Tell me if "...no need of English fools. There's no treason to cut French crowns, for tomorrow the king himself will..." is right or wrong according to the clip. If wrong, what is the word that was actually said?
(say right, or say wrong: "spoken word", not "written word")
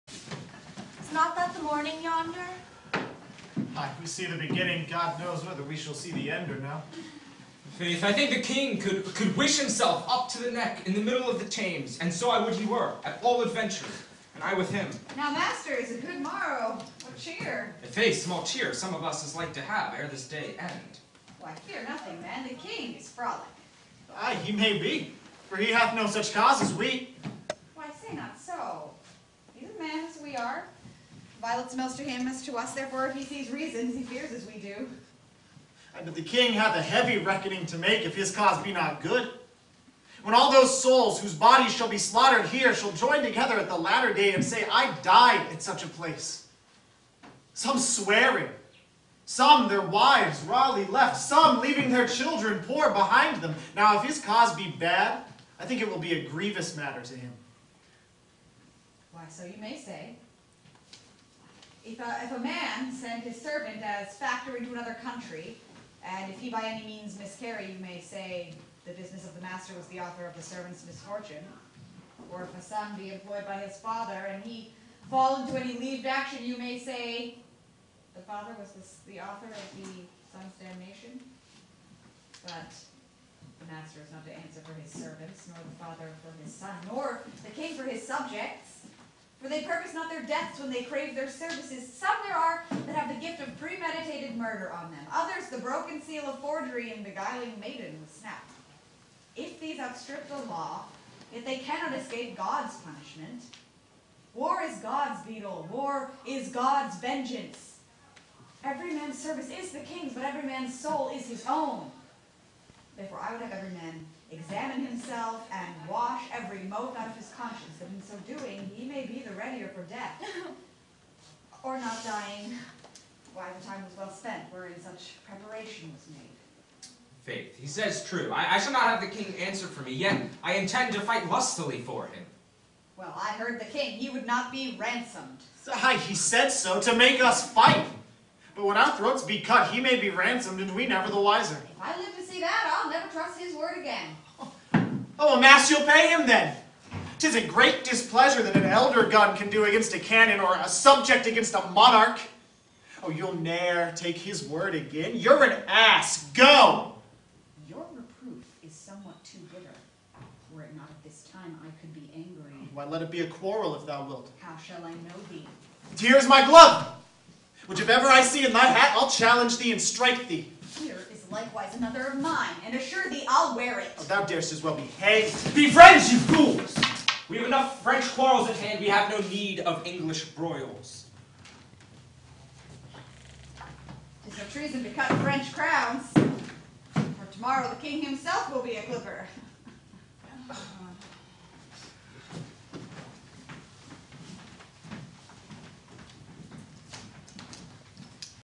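wrong: "broils", not "fools".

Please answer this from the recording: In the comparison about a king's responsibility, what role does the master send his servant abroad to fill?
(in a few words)
factor.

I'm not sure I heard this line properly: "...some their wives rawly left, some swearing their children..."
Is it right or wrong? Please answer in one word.
wrong.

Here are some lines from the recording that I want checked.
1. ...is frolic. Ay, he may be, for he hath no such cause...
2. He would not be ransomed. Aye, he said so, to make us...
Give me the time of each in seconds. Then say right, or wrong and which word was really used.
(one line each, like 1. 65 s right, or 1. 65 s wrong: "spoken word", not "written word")
1. 22 s right
2. 133 s right.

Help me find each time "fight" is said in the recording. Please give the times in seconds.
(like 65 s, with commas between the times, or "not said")
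131 s, 137 s.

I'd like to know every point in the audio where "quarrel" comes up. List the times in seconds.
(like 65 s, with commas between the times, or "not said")
163 s, 178 s.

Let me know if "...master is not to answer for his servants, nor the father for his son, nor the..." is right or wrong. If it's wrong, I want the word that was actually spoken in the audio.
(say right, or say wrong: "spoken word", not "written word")
right.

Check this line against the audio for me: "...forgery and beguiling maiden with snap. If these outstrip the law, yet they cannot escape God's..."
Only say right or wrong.
right.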